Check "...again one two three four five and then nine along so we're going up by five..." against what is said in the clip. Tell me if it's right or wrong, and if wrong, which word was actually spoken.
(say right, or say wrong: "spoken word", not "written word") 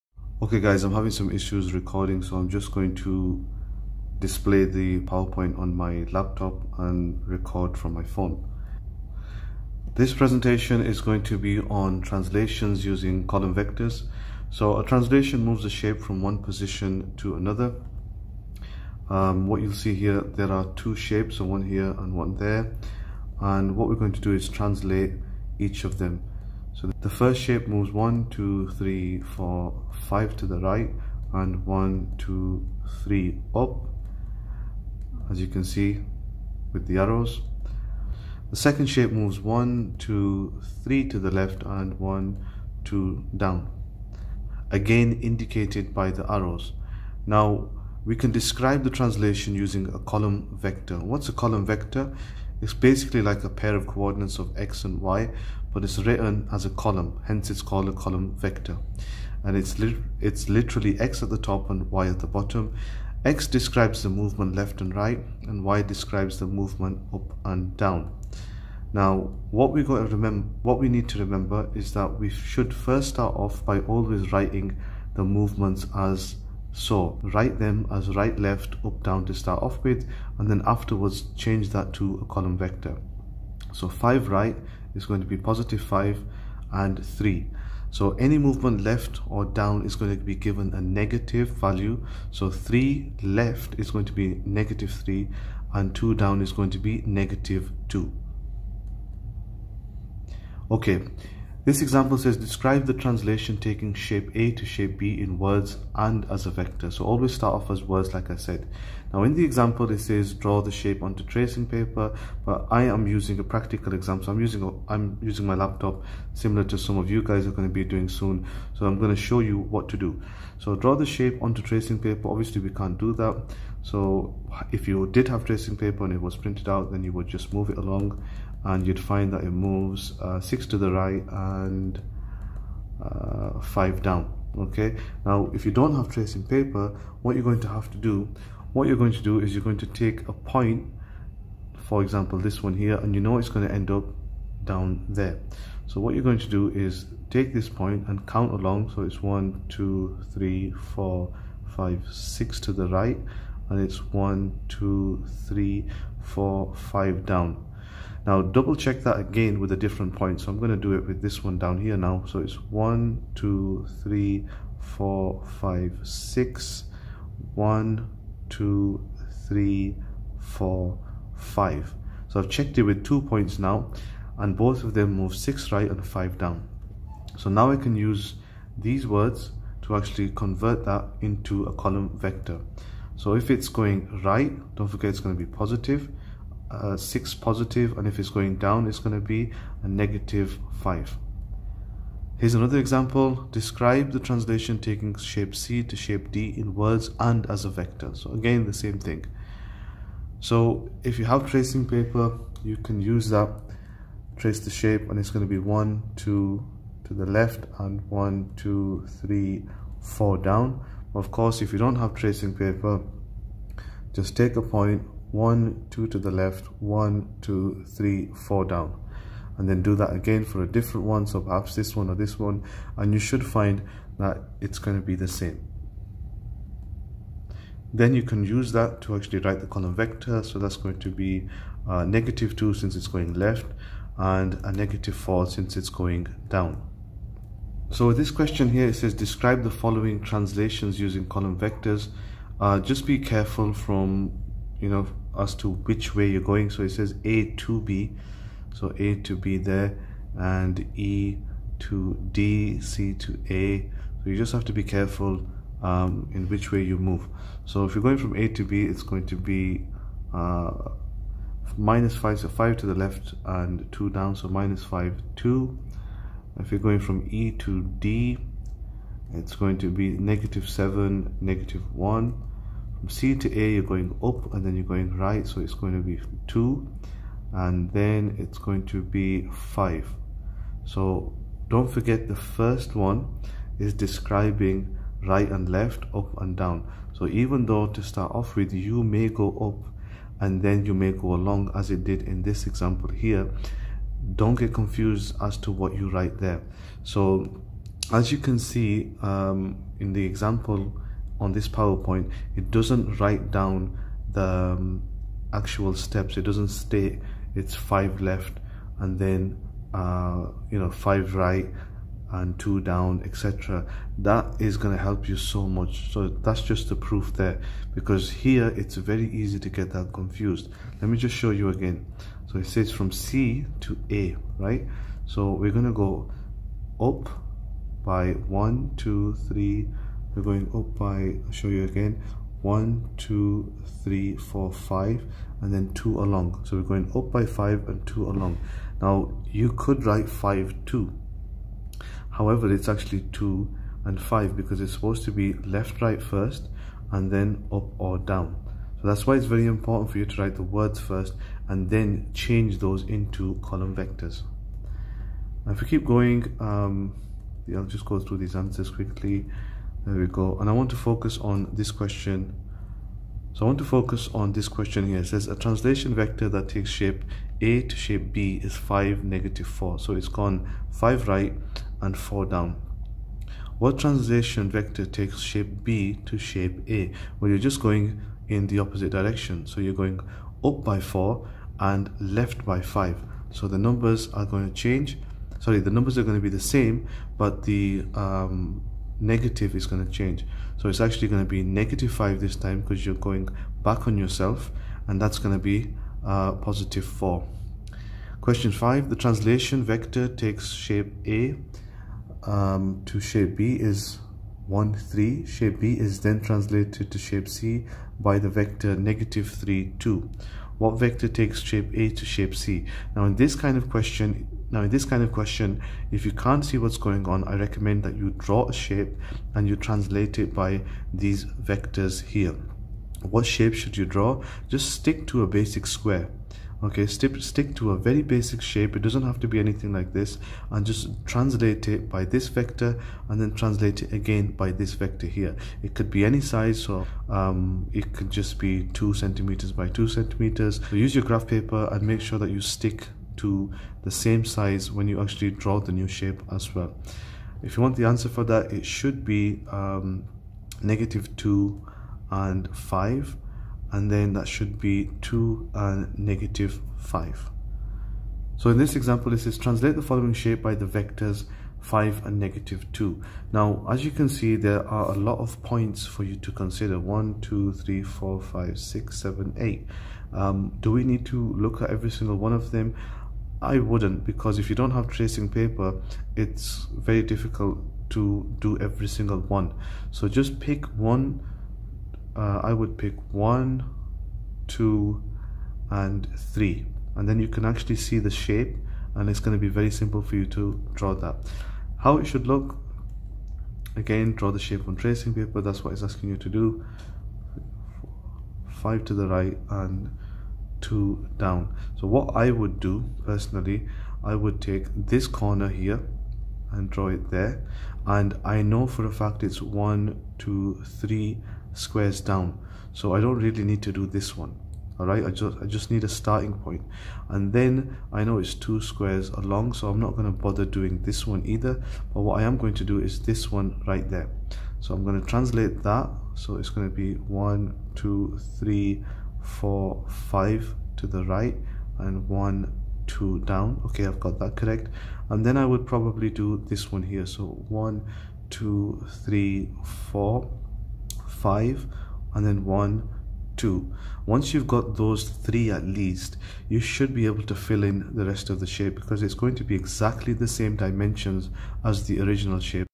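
wrong: "two", not "nine".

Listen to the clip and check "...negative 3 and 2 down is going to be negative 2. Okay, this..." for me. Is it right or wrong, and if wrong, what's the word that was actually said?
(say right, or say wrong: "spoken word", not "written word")
right.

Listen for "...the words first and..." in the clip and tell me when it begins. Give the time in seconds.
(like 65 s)
350 s.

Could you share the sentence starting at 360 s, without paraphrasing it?
And I want to focus on this question.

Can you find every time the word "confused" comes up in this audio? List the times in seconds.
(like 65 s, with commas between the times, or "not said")
294 s, 320 s.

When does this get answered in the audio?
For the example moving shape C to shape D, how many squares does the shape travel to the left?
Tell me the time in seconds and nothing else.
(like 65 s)
205 s.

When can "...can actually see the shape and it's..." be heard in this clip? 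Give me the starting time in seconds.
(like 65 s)
487 s.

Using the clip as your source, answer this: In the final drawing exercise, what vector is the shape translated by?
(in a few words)
5, -2.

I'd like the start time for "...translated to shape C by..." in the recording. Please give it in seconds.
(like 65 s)
406 s.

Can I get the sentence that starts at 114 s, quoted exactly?
So I'm using i I'm using my laptop similar to some of you guys are going to be doing soon.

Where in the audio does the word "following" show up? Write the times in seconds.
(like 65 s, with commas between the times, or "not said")
239 s, 460 s.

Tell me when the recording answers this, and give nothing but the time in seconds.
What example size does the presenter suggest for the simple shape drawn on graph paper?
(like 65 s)
438 s.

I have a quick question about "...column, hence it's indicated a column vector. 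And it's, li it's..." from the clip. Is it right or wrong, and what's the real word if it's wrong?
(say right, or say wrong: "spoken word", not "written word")
wrong: "called", not "indicated".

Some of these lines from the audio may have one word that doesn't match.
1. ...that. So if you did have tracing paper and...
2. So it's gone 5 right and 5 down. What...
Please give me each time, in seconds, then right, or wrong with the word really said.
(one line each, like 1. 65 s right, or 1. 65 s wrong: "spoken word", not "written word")
1. 123 s right
2. 369 s wrong: "4", not "5".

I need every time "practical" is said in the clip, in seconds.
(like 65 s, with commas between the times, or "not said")
113 s.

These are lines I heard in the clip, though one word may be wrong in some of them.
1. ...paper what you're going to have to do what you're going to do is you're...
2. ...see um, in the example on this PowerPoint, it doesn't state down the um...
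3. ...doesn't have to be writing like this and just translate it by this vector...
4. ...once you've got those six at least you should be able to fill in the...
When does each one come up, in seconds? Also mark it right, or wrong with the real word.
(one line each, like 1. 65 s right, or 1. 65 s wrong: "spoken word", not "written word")
1. 136 s right
2. 298 s wrong: "write", not "state"
3. 429 s wrong: "anything", not "writing"
4. 544 s wrong: "three", not "six".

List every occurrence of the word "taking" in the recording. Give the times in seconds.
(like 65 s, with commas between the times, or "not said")
103 s, 194 s.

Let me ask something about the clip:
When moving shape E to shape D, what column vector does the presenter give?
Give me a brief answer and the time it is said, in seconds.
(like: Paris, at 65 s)
-7, -1, at 270 s.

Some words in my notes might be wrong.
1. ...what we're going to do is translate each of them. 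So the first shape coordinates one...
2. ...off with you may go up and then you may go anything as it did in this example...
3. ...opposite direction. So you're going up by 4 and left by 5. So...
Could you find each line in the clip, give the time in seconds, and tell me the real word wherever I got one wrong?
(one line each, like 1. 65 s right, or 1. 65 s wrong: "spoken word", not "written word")
1. 23 s wrong: "moves", not "coordinates"
2. 288 s wrong: "along", not "anything"
3. 378 s right.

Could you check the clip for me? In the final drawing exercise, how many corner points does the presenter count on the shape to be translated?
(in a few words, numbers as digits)
8.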